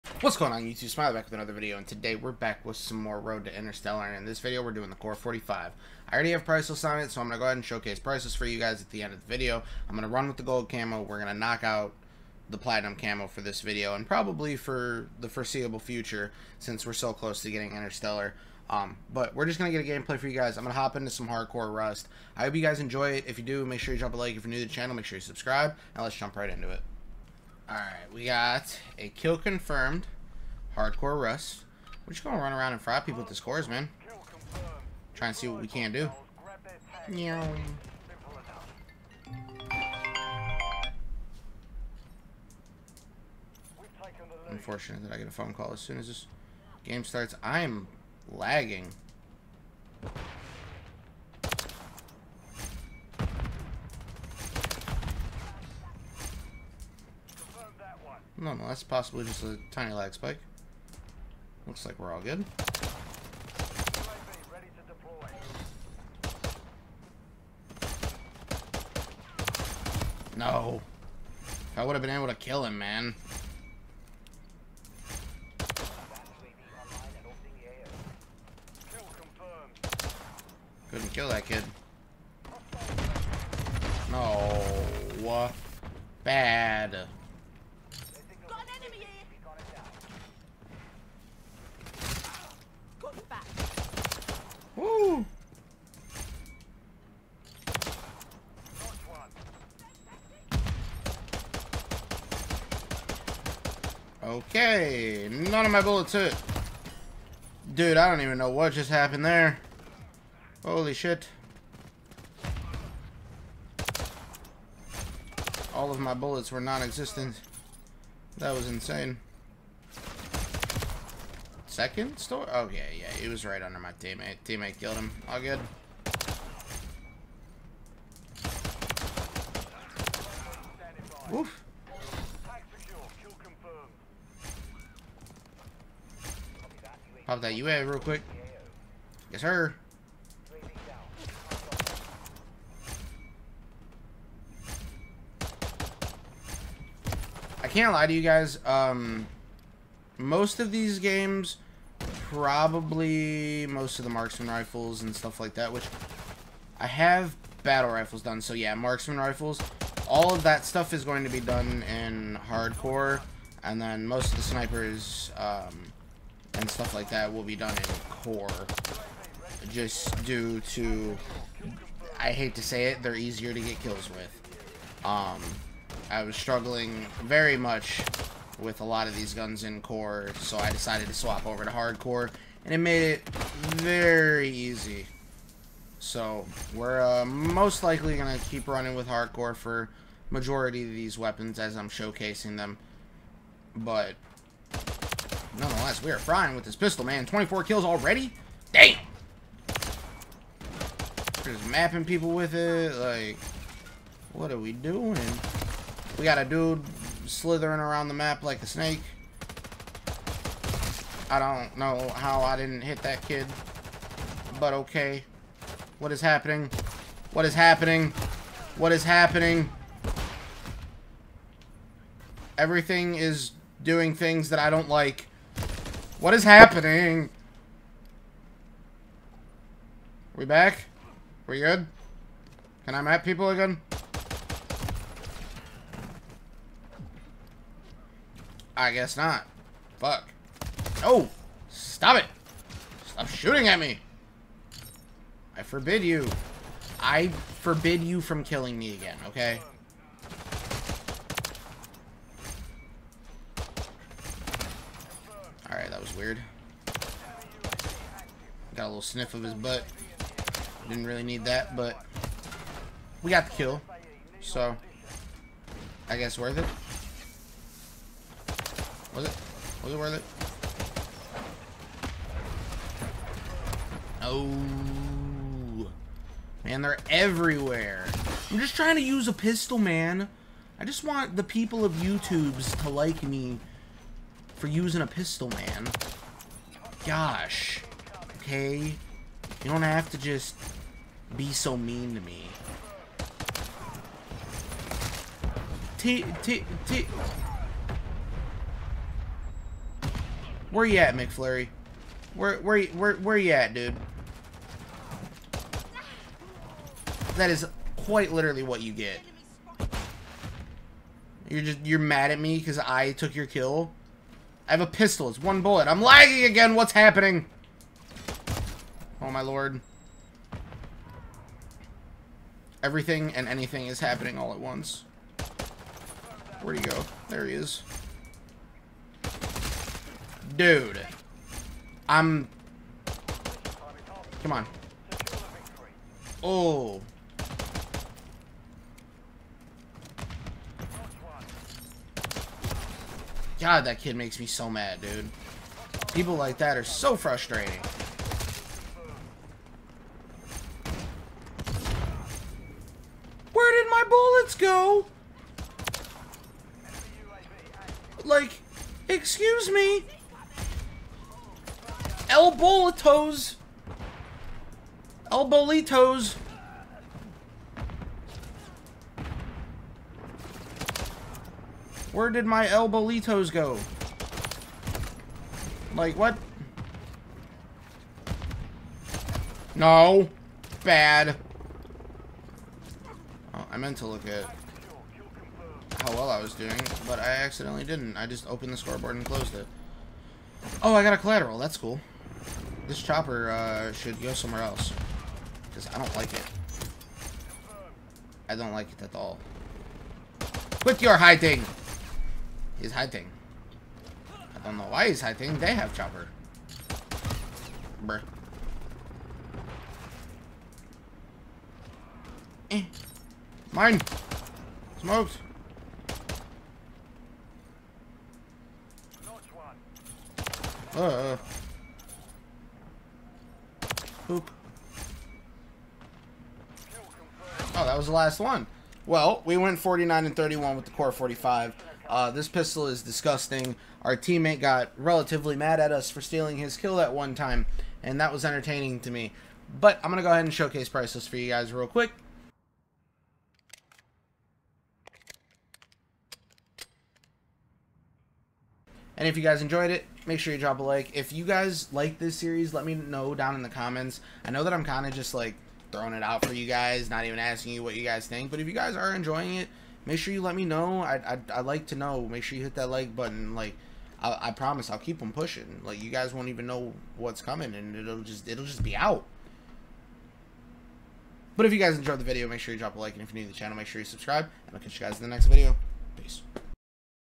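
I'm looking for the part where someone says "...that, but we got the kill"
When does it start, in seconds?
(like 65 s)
261 s.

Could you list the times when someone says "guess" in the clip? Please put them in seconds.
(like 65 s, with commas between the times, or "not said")
238 s, 266 s.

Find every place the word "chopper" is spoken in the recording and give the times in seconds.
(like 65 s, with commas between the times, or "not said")
393 s, 405 s.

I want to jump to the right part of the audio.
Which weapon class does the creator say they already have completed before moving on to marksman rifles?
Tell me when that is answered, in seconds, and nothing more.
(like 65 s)
157 s.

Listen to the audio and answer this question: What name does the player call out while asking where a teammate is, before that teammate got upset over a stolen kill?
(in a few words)
McFlurry.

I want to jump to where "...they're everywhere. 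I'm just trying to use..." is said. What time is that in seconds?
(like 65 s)
276 s.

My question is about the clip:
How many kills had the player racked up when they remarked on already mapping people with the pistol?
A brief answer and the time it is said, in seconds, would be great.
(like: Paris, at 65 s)
24, at 197 s.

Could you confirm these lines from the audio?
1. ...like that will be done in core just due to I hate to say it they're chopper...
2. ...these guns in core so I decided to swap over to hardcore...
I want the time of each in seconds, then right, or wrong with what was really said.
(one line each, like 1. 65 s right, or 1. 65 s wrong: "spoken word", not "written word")
1. 166 s wrong: "easier", not "chopper"
2. 179 s right.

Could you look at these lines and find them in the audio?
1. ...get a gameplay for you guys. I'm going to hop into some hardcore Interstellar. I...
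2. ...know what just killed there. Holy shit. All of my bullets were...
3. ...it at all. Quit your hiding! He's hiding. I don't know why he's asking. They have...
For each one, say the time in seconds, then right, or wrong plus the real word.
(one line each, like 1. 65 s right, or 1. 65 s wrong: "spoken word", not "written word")
1. 19 s wrong: "Rust", not "Interstellar"
2. 108 s wrong: "happened", not "killed"
3. 398 s wrong: "hiding", not "asking".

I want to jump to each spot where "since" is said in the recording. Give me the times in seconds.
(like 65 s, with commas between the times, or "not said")
16 s.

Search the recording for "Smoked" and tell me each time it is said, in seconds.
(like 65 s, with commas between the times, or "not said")
414 s.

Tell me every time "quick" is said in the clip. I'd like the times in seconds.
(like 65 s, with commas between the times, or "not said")
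137 s, 441 s.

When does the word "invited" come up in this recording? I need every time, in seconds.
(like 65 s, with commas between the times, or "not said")
not said.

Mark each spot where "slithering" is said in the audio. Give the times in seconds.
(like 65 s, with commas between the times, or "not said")
207 s.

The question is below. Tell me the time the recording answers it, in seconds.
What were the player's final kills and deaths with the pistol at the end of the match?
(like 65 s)
429 s.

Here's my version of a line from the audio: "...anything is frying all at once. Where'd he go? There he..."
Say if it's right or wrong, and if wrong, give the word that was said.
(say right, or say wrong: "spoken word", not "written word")
wrong: "happening", not "frying".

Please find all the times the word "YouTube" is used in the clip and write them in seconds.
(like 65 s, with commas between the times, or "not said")
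0 s, 281 s.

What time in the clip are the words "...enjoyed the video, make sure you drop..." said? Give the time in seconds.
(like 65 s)
471 s.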